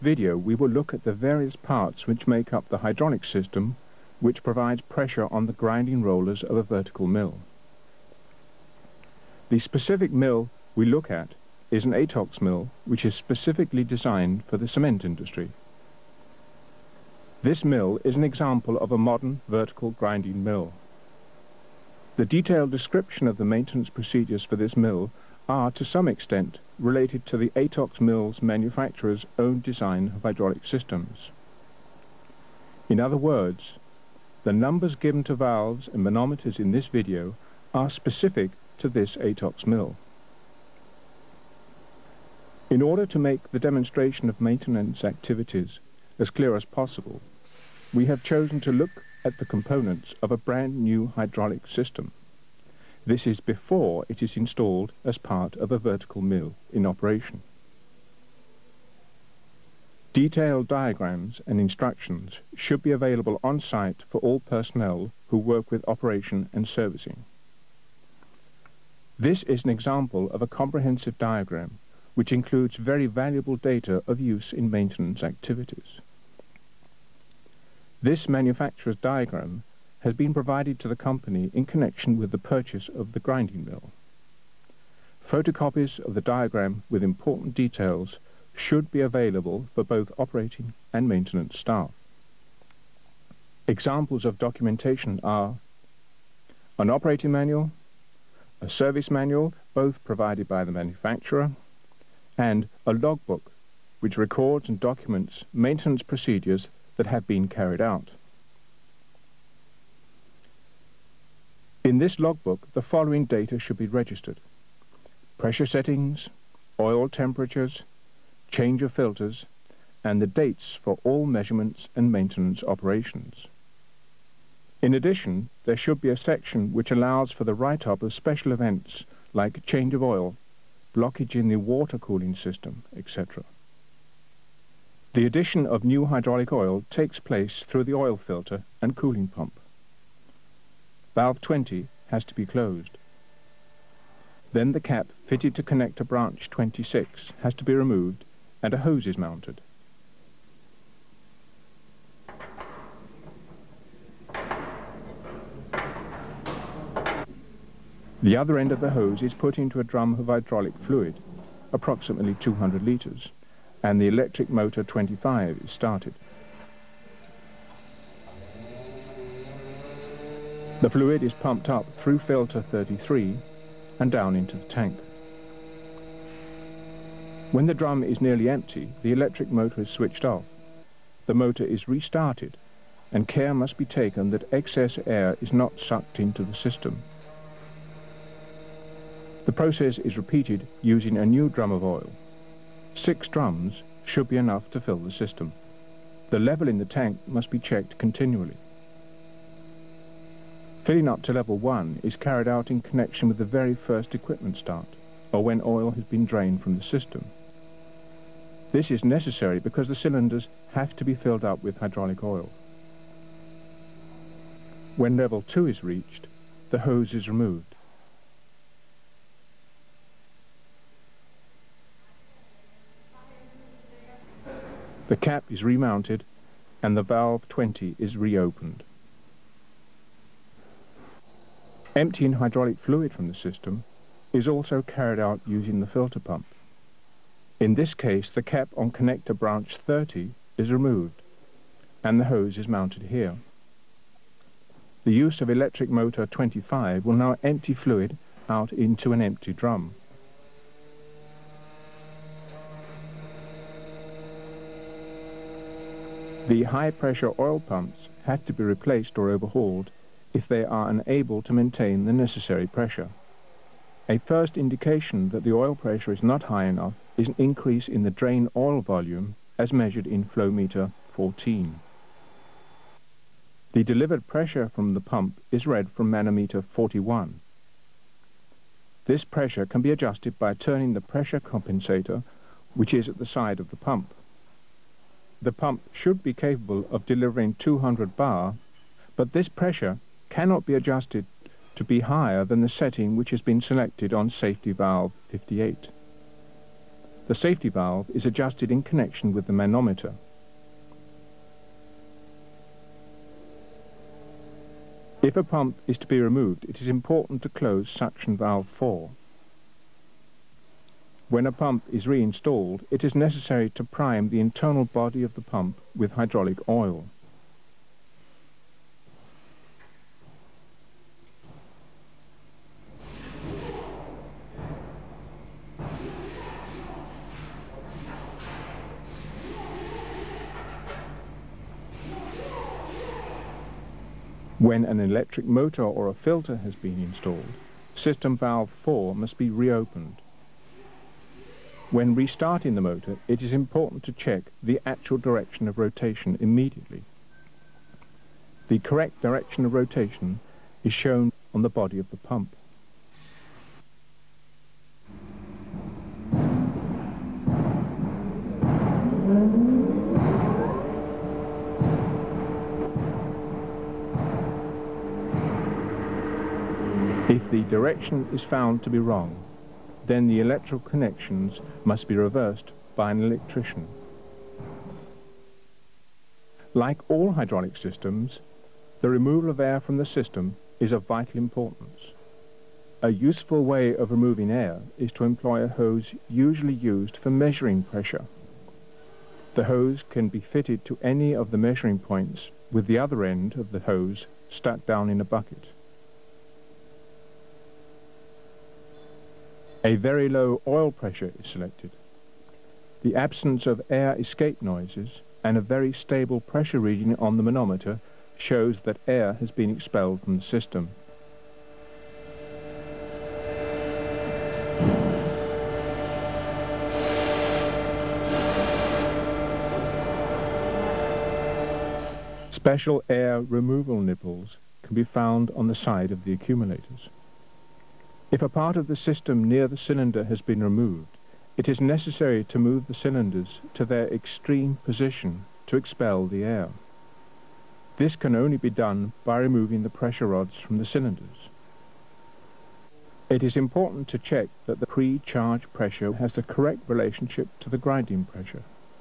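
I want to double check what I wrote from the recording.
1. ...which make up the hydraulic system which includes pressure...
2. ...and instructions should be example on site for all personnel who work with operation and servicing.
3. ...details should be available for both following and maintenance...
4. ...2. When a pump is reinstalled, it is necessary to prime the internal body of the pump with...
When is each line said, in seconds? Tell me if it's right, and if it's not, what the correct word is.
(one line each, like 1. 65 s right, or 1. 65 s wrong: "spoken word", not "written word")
1. 2 s wrong: "provides", not "includes"
2. 61 s wrong: "available", not "example"
3. 87 s wrong: "operating", not "following"
4. 308 s wrong: "4", not "2".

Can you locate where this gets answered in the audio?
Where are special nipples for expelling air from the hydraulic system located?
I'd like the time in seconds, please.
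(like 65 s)
425 s.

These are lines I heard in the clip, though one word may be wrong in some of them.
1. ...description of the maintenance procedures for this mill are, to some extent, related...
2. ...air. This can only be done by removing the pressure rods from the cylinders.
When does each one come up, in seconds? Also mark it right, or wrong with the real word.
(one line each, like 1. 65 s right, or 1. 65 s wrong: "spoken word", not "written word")
1. 22 s right
2. 436 s right.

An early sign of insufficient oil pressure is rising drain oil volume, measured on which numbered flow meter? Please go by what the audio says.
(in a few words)
14.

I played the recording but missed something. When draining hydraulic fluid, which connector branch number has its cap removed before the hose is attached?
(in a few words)
30.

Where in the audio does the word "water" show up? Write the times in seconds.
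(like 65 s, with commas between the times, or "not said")
131 s.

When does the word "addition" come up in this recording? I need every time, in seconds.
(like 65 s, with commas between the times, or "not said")
124 s, 135 s.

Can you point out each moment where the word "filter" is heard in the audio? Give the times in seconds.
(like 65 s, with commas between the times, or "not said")
118 s, 138 s, 172 s, 235 s, 336 s.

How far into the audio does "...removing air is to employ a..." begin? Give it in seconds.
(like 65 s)
384 s.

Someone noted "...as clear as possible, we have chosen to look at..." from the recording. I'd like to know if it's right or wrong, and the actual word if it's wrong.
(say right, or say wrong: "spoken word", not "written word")
right.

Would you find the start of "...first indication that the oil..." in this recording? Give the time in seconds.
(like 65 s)
264 s.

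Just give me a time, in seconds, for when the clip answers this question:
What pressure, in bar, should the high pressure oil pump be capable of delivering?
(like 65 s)
287 s.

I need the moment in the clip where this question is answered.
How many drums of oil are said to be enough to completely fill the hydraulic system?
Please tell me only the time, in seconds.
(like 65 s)
192 s.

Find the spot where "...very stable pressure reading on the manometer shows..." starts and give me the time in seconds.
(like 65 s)
405 s.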